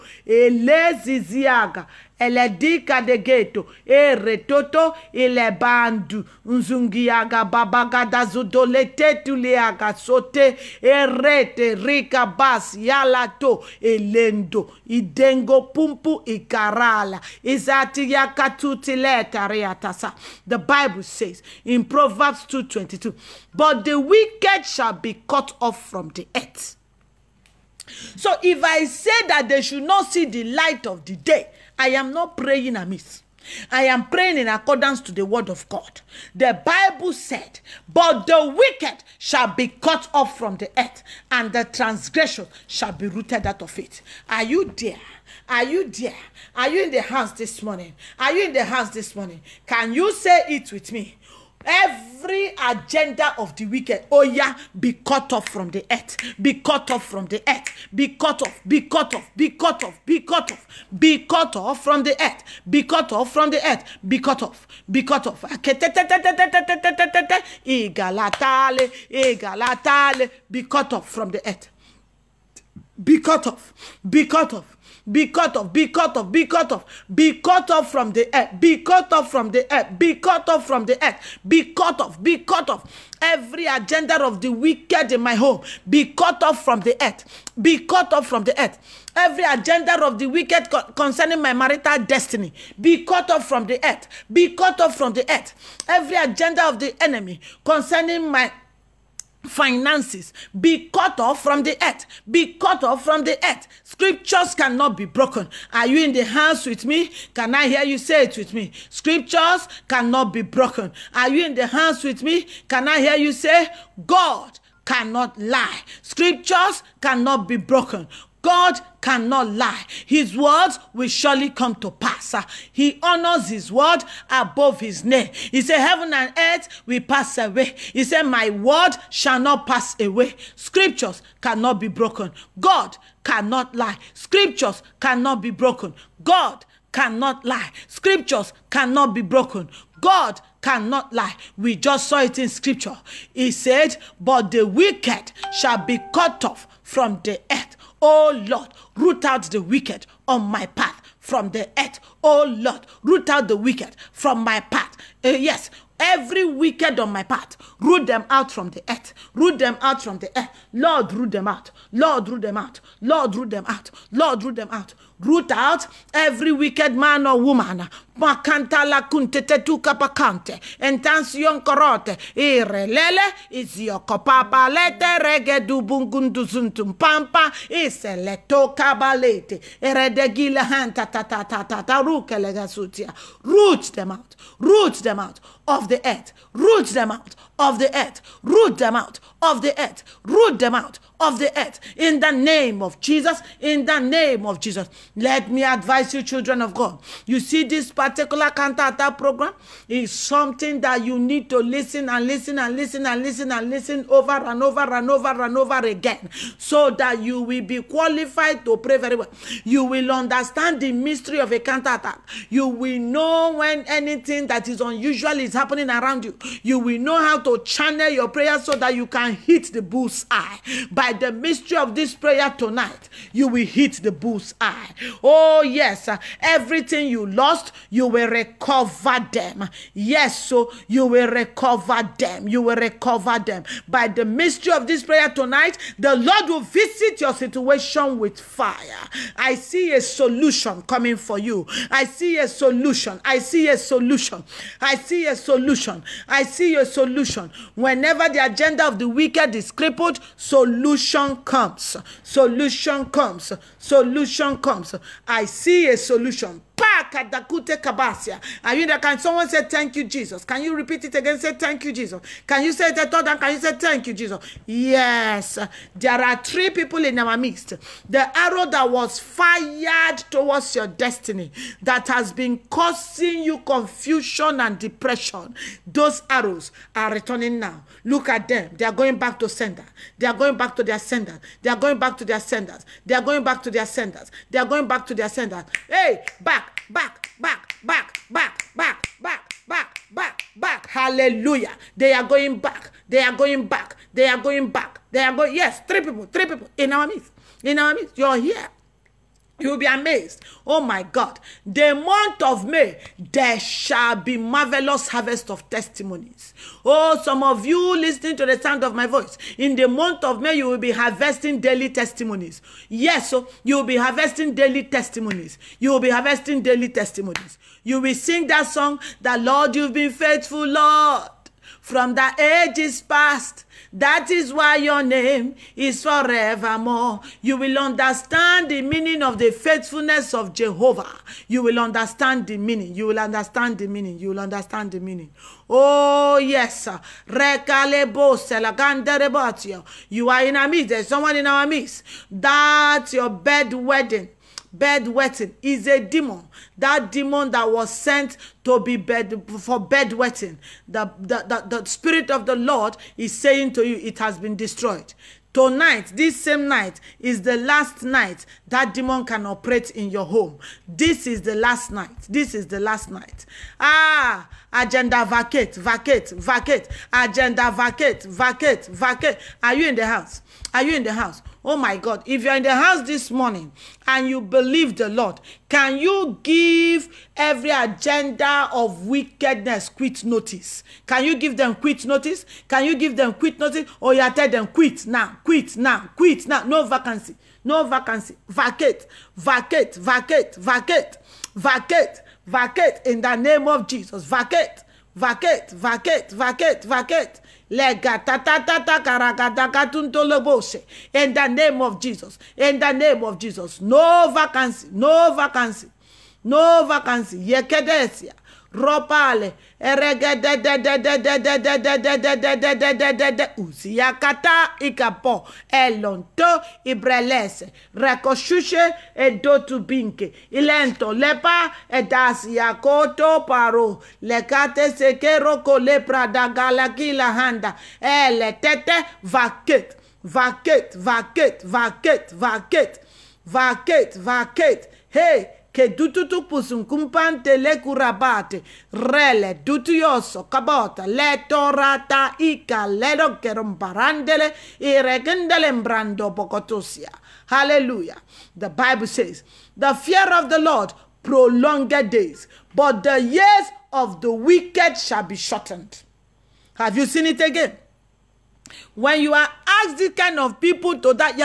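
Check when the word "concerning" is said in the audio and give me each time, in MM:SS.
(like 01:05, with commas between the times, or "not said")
01:30, 01:37.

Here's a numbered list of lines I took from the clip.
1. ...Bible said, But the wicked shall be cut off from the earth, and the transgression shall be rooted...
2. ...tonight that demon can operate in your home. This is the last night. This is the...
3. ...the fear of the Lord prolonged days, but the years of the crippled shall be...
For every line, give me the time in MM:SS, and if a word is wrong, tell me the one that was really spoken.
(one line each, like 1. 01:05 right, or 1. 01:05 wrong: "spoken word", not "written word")
1. 00:36 right
2. 05:58 wrong: "night", not "tonight"
3. 07:29 wrong: "wicked", not "crippled".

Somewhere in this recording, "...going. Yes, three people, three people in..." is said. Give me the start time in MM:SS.
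04:55.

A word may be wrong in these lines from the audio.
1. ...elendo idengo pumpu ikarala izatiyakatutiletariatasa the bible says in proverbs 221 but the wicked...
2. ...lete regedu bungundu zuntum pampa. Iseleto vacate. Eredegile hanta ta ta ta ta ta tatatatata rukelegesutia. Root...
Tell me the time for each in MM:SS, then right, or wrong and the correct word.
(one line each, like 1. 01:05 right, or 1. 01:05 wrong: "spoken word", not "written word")
1. 00:13 wrong: "222", not "221"
2. 02:54 wrong: "kabalete", not "vacate".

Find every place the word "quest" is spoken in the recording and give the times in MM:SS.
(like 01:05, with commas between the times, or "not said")
not said.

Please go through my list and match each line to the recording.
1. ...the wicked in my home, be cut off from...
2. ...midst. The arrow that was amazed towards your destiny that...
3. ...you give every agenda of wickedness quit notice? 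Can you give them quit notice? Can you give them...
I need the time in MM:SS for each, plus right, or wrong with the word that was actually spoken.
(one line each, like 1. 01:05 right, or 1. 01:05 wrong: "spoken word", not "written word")
1. 01:24 right
2. 04:27 wrong: "fired", not "amazed"
3. 06:15 right.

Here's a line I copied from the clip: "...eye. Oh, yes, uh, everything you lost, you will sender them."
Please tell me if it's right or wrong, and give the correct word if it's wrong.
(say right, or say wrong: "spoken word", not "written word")
wrong: "recover", not "sender".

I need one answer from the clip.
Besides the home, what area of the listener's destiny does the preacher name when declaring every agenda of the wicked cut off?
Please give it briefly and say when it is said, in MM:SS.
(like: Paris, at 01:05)
marital destiny, at 01:31.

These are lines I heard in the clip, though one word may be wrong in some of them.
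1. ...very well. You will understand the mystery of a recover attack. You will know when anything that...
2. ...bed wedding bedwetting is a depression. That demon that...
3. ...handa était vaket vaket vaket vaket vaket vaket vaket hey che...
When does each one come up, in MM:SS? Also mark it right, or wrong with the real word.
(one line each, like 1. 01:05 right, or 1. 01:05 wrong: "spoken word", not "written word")
1. 03:28 wrong: "counter", not "recover"
2. 05:43 wrong: "demon", not "depression"
3. 07:07 right.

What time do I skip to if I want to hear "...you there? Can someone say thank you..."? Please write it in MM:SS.
04:18.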